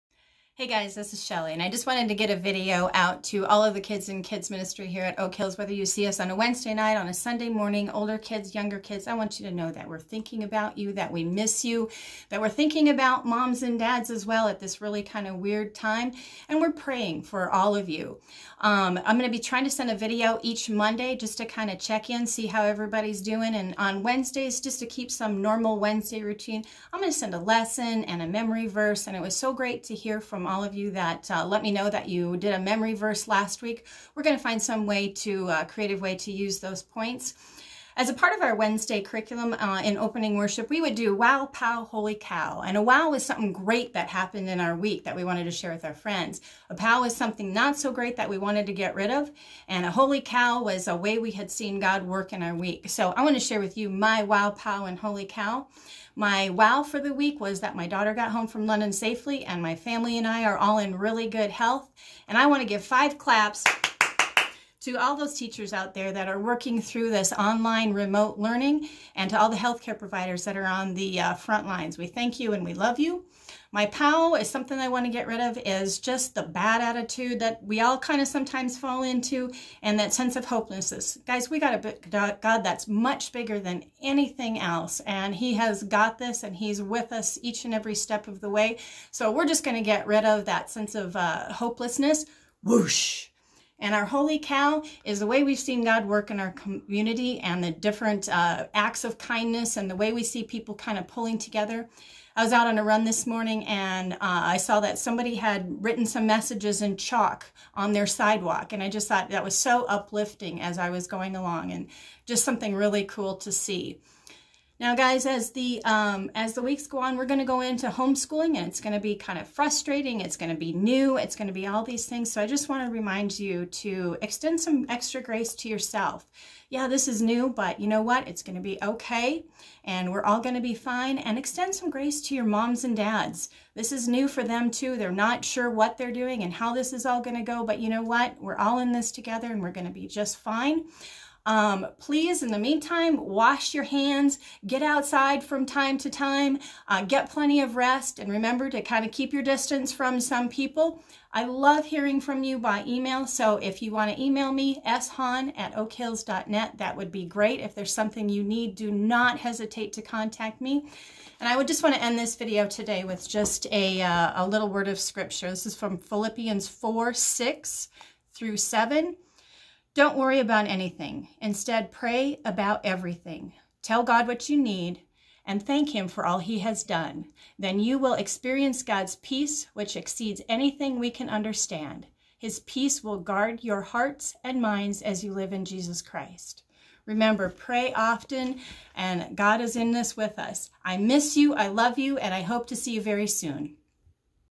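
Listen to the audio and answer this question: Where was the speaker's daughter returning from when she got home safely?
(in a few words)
London.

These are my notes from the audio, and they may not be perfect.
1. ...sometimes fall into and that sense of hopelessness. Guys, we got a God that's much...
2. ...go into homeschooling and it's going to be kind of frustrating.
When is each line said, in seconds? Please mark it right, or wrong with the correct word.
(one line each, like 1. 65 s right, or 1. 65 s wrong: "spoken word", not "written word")
1. 78 s right
2. 117 s right.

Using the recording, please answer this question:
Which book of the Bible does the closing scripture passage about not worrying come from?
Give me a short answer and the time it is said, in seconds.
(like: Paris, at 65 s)
Philippians, at 165 s.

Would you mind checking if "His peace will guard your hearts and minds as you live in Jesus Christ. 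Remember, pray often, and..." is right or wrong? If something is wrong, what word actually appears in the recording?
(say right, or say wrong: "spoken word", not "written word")
right.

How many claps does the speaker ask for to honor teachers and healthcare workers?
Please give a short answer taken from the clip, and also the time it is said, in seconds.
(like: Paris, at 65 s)
5, at 62 s.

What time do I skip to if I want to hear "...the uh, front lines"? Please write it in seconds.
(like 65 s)
70 s.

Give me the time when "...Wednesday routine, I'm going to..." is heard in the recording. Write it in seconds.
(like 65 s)
25 s.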